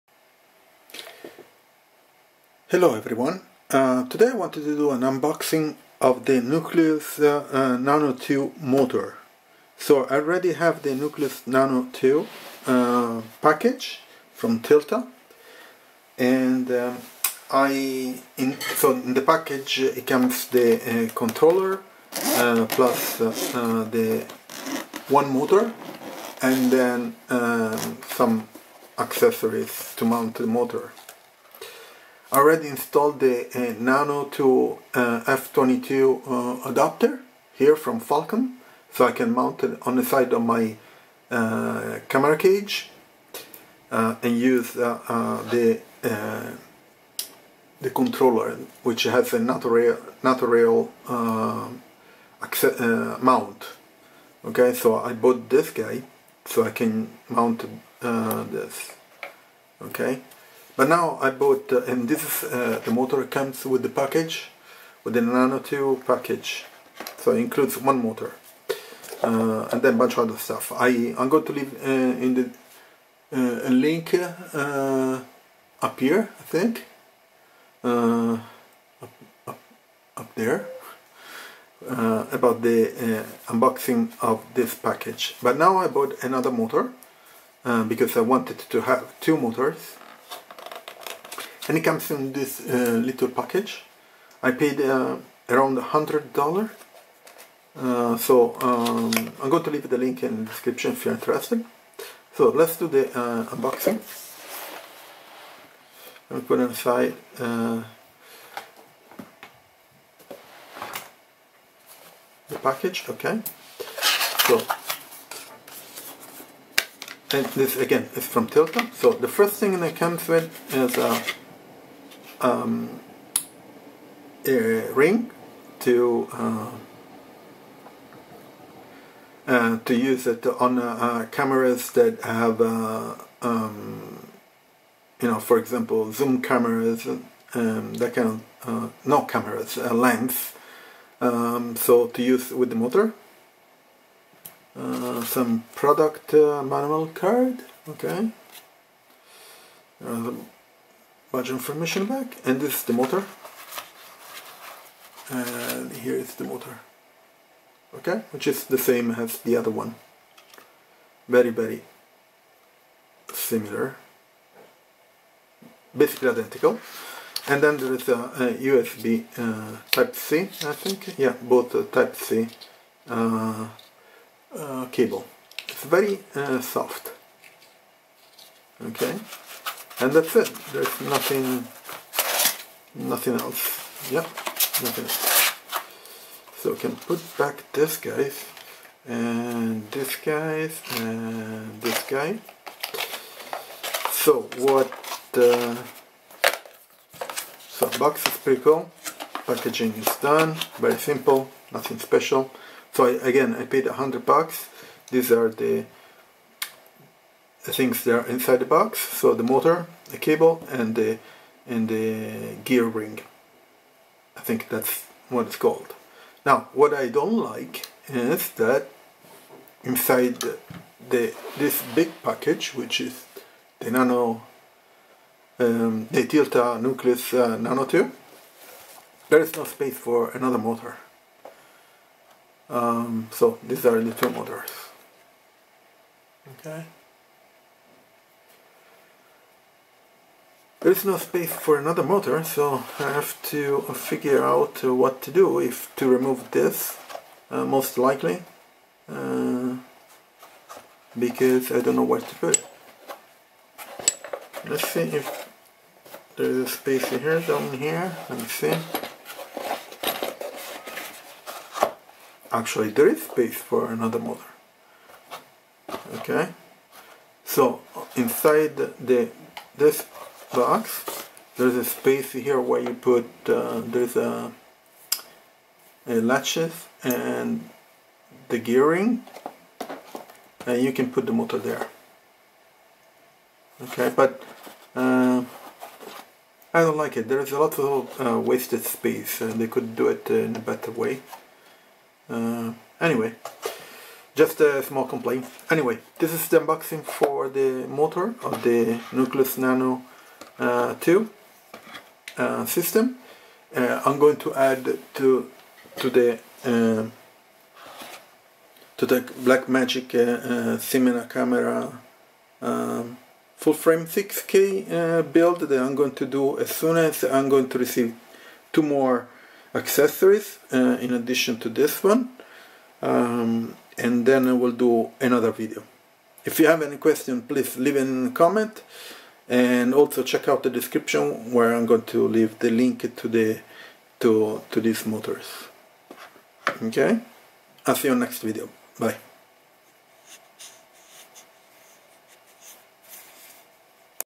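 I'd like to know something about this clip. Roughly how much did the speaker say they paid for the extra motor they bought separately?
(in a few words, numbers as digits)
$100.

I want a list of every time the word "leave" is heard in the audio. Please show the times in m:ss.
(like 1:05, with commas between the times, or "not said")
1:11, 1:39, 5:27, 5:32.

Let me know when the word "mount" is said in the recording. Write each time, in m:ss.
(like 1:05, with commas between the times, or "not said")
0:30, 0:39, 0:53, 0:57.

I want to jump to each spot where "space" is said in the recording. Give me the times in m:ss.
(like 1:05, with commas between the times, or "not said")
3:49, 4:01, 4:16, 4:23, 4:31, 4:48.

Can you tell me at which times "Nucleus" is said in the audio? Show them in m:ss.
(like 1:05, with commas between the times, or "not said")
0:06, 0:10, 3:46, 4:59.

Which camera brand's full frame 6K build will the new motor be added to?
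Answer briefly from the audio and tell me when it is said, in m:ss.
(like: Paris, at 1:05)
Blackmagic, at 5:09.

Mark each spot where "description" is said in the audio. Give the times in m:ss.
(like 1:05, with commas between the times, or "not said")
1:40, 5:30.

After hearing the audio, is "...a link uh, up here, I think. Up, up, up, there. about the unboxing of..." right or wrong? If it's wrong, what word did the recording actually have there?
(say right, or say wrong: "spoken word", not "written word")
right.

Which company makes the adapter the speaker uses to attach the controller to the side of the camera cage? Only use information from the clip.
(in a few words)
Falcam.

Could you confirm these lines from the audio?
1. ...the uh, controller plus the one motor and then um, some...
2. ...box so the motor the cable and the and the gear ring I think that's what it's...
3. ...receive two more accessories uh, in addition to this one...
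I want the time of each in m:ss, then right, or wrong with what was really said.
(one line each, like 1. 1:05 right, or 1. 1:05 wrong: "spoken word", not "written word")
1. 0:20 right
2. 3:28 right
3. 5:17 right.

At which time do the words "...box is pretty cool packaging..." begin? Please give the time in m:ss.
3:17.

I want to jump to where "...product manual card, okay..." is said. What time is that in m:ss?
2:25.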